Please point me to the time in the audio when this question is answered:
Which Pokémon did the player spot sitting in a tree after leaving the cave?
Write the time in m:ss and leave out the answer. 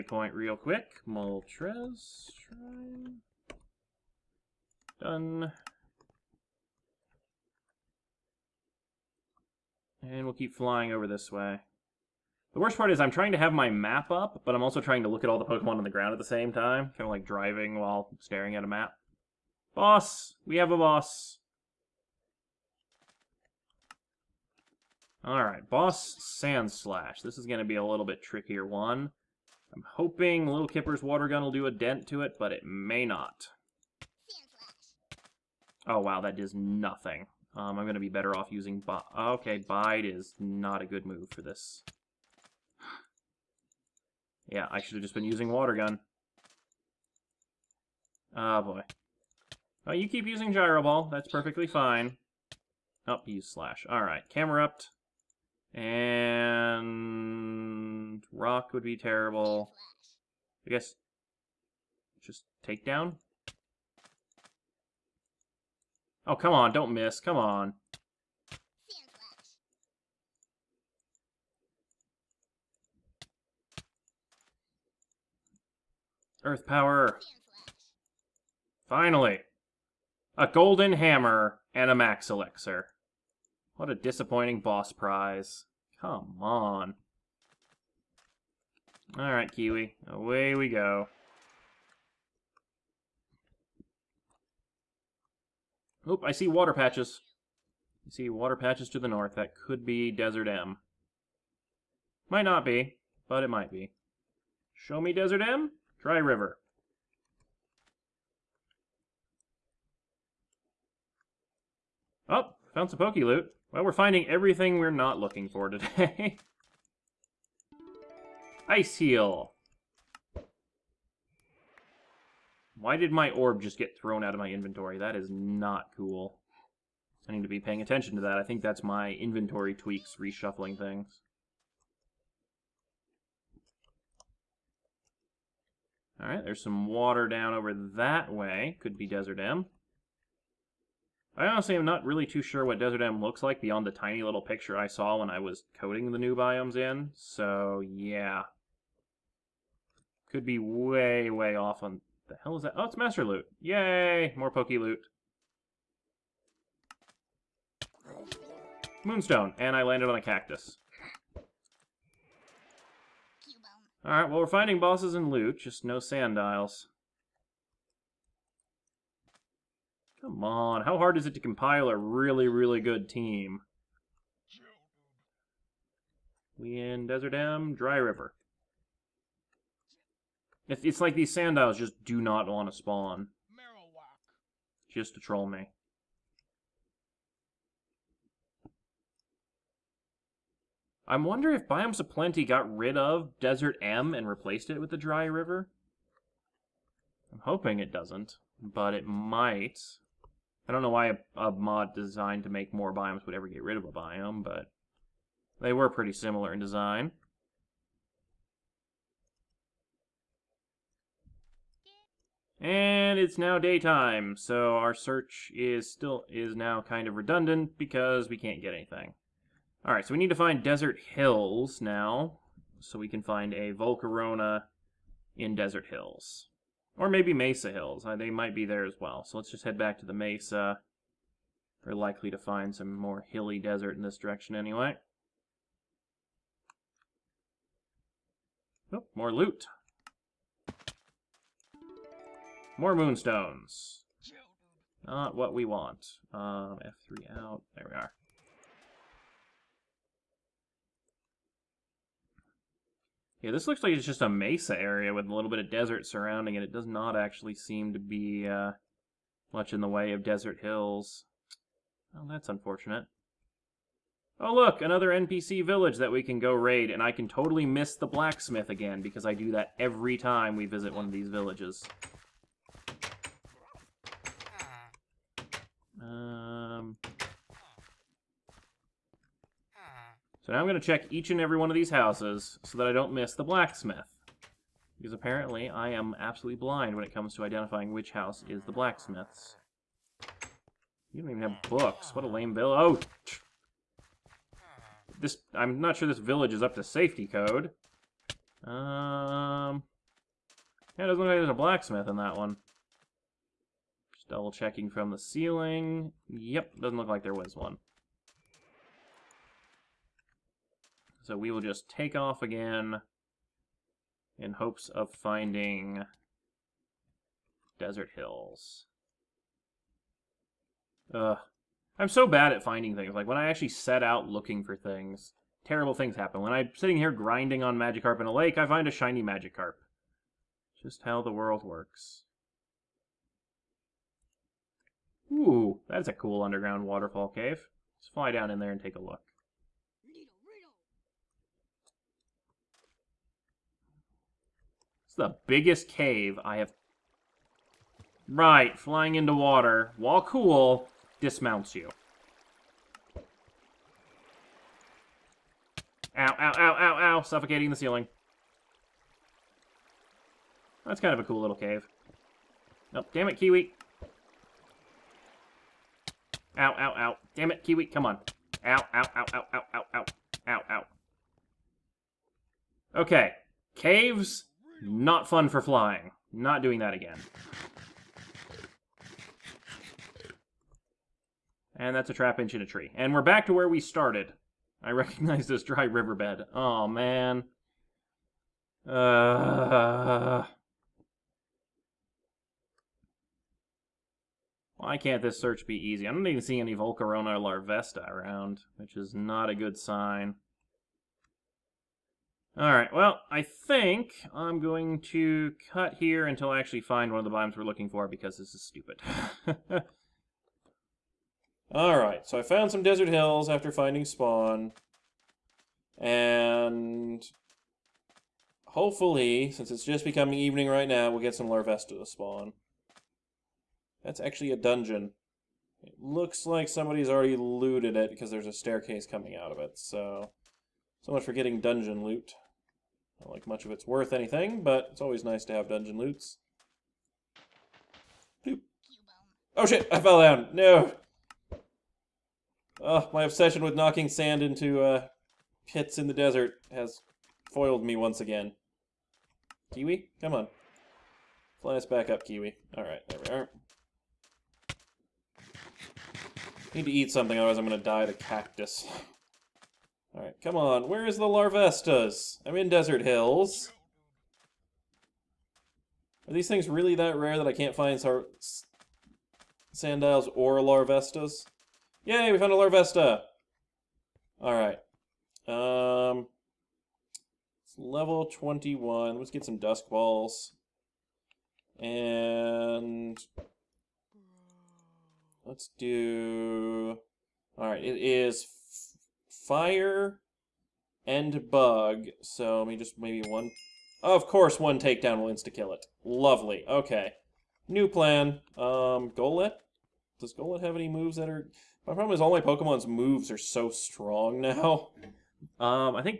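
6:22.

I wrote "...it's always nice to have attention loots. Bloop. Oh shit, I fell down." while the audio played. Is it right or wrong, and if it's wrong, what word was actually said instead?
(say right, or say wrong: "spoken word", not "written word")
wrong: "dungeon", not "attention".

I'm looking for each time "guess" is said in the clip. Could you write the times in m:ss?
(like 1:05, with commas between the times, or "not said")
1:00.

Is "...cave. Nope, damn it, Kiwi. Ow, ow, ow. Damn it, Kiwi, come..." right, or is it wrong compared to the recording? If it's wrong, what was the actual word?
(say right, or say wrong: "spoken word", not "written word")
right.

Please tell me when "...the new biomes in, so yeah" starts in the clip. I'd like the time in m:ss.
2:26.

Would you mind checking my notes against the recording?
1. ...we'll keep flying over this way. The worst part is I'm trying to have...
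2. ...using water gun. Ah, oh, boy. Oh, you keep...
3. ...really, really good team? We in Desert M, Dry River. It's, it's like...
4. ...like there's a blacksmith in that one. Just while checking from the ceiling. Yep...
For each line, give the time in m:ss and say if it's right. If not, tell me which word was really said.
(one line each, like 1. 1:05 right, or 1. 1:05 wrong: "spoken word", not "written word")
1. 0:10 right
2. 0:45 right
3. 2:51 right
4. 5:01 wrong: "double", not "while".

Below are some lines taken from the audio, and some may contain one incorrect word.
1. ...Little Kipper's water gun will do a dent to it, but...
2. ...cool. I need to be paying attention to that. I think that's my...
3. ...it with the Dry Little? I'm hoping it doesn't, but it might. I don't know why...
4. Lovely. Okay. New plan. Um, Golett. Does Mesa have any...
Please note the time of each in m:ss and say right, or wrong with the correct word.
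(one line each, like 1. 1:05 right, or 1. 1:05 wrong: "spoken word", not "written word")
1. 0:30 right
2. 2:05 right
3. 3:14 wrong: "River", not "Little"
4. 8:16 wrong: "Golett", not "Mesa".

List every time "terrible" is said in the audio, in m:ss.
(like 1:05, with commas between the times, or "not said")
0:58, 5:25.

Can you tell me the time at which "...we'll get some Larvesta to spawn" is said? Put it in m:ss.
7:01.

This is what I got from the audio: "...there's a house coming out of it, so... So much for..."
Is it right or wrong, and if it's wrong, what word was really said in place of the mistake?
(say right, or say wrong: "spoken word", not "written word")
wrong: "staircase", not "house".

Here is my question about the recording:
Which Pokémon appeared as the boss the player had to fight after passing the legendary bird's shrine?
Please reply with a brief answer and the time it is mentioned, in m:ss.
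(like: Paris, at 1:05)
Sandslash, at 0:26.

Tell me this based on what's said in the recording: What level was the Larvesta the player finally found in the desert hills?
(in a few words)
21.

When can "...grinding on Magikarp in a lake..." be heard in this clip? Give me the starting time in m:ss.
5:27.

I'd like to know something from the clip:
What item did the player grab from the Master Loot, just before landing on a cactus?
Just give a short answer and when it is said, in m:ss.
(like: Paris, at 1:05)
Moonstone, at 2:39.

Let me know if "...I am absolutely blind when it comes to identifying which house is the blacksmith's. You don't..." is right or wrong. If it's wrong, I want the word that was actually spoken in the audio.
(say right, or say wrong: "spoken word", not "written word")
right.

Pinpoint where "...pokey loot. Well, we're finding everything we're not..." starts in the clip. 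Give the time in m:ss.
1:52.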